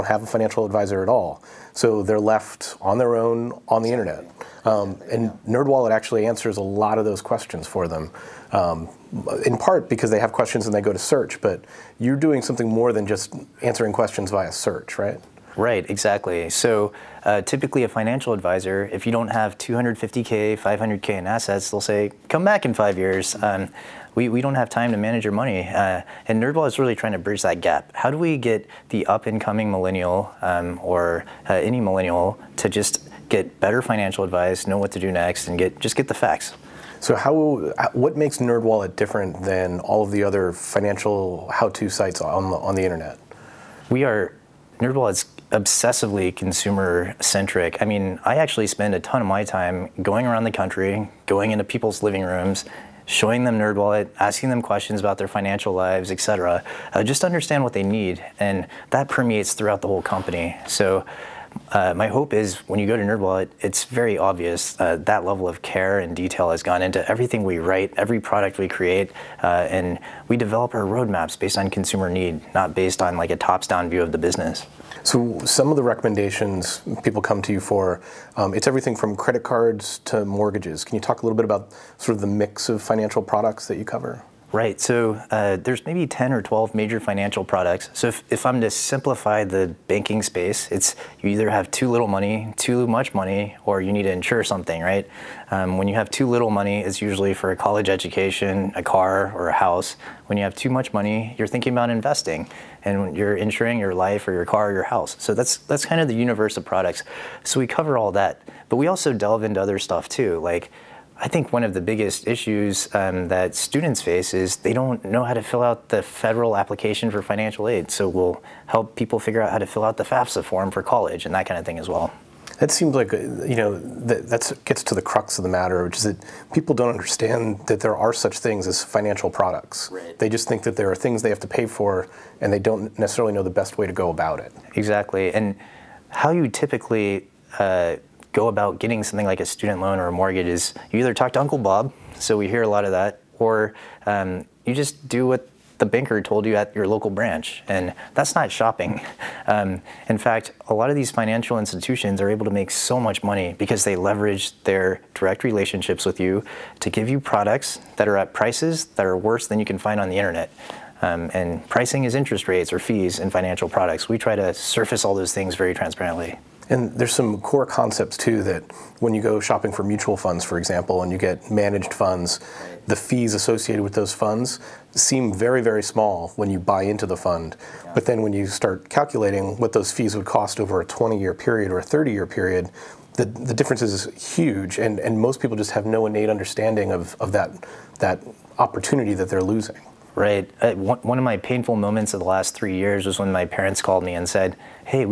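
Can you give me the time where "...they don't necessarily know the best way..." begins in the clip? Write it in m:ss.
2:12.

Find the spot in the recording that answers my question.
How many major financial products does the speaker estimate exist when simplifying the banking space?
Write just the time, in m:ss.
1:26.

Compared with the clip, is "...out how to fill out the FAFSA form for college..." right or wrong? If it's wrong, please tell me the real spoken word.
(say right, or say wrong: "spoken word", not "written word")
right.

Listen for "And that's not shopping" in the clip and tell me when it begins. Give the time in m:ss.
2:27.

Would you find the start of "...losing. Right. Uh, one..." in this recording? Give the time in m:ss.
3:09.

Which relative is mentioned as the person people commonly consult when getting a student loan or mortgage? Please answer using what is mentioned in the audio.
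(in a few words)
Uncle Bob.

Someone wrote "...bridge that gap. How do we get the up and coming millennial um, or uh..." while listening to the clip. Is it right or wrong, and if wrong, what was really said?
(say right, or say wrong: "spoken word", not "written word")
right.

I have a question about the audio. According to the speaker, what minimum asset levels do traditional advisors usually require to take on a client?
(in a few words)
250K, 500K.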